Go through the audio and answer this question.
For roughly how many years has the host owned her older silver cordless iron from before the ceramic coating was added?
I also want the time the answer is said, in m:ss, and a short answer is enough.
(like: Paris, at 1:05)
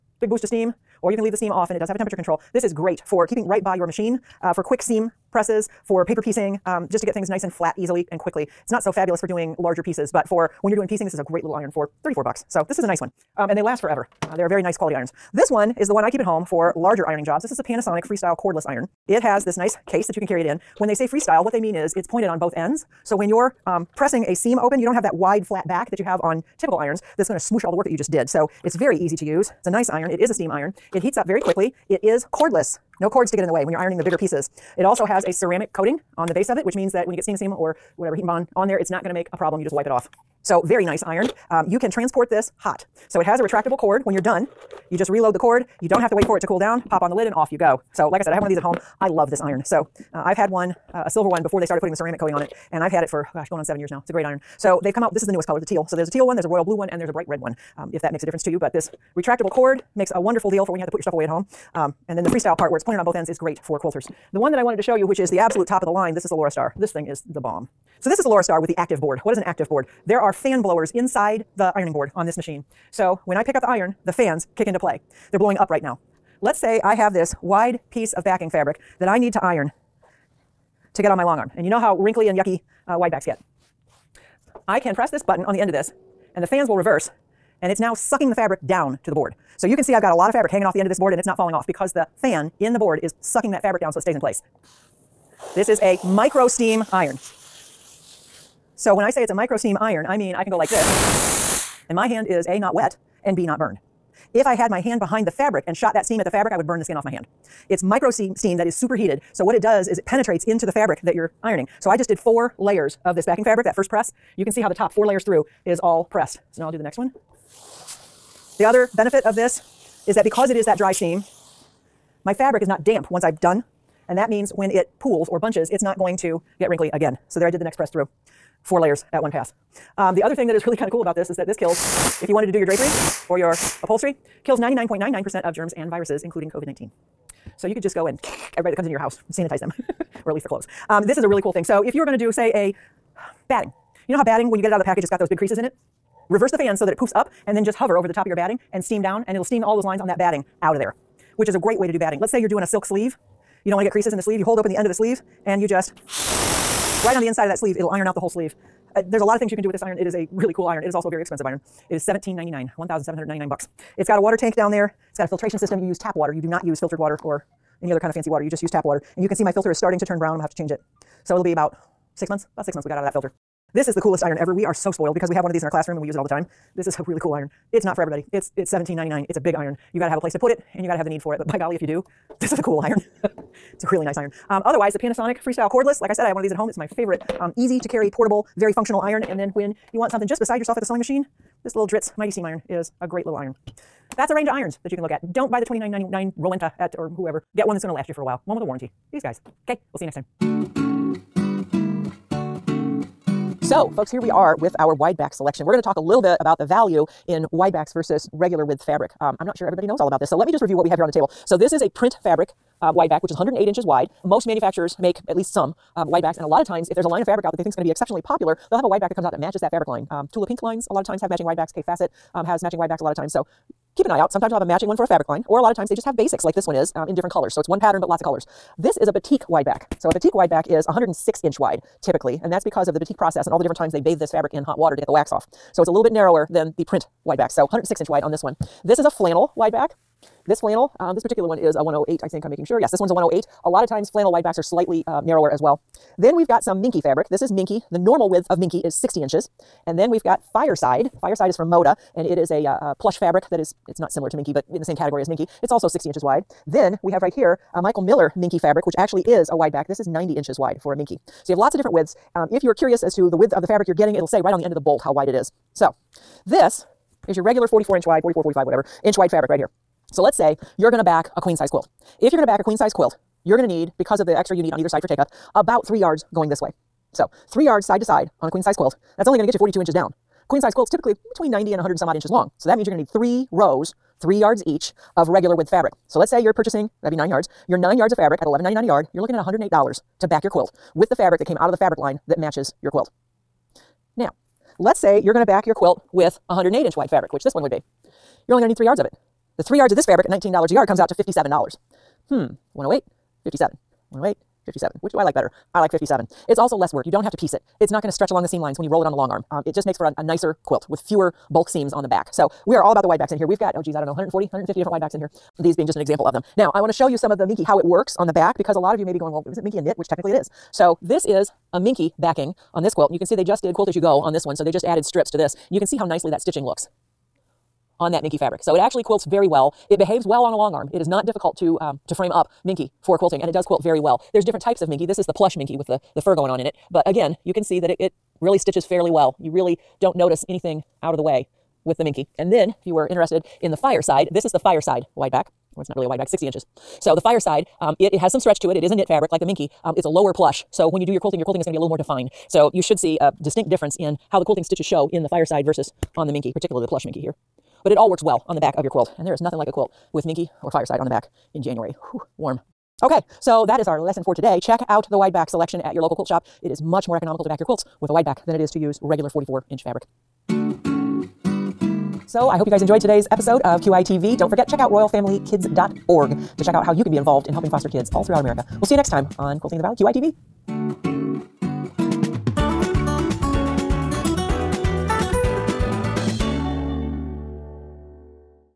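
7, at 0:53.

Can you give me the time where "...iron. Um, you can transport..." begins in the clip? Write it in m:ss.
0:41.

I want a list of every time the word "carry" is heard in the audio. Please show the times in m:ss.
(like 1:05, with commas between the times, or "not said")
0:20, 3:07.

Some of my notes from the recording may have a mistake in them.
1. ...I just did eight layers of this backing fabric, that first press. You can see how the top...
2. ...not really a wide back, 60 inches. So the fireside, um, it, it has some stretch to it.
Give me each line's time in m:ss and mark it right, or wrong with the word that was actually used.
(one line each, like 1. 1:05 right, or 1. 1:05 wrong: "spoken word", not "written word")
1. 1:51 wrong: "four", not "eight"
2. 5:45 right.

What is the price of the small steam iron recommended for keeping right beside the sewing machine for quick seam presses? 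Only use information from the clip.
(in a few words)
$34.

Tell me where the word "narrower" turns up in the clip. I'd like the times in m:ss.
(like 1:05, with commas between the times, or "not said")
3:56, 4:05.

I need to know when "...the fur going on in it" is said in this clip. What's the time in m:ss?
5:36.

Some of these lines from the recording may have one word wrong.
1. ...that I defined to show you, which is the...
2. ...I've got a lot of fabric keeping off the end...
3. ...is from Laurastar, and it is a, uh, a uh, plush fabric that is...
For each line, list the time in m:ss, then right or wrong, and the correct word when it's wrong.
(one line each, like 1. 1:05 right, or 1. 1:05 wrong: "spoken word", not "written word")
1. 1:04 wrong: "wanted", not "defined"
2. 1:29 wrong: "hanging", not "keeping"
3. 4:11 wrong: "Moda", not "Laurastar".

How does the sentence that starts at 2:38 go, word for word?
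Uh, there's a lot of things you can do with this iron.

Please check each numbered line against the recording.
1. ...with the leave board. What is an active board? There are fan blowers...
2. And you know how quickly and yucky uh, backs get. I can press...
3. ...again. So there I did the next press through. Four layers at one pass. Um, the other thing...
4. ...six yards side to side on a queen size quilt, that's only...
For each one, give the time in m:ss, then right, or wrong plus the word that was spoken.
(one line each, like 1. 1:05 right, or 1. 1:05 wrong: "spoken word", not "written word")
1. 1:08 wrong: "active", not "leave"
2. 1:21 wrong: "wrinkly", not "quickly"
3. 2:06 right
4. 4:37 wrong: "three", not "six".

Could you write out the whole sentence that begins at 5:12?
So we are all about the wide backs in here.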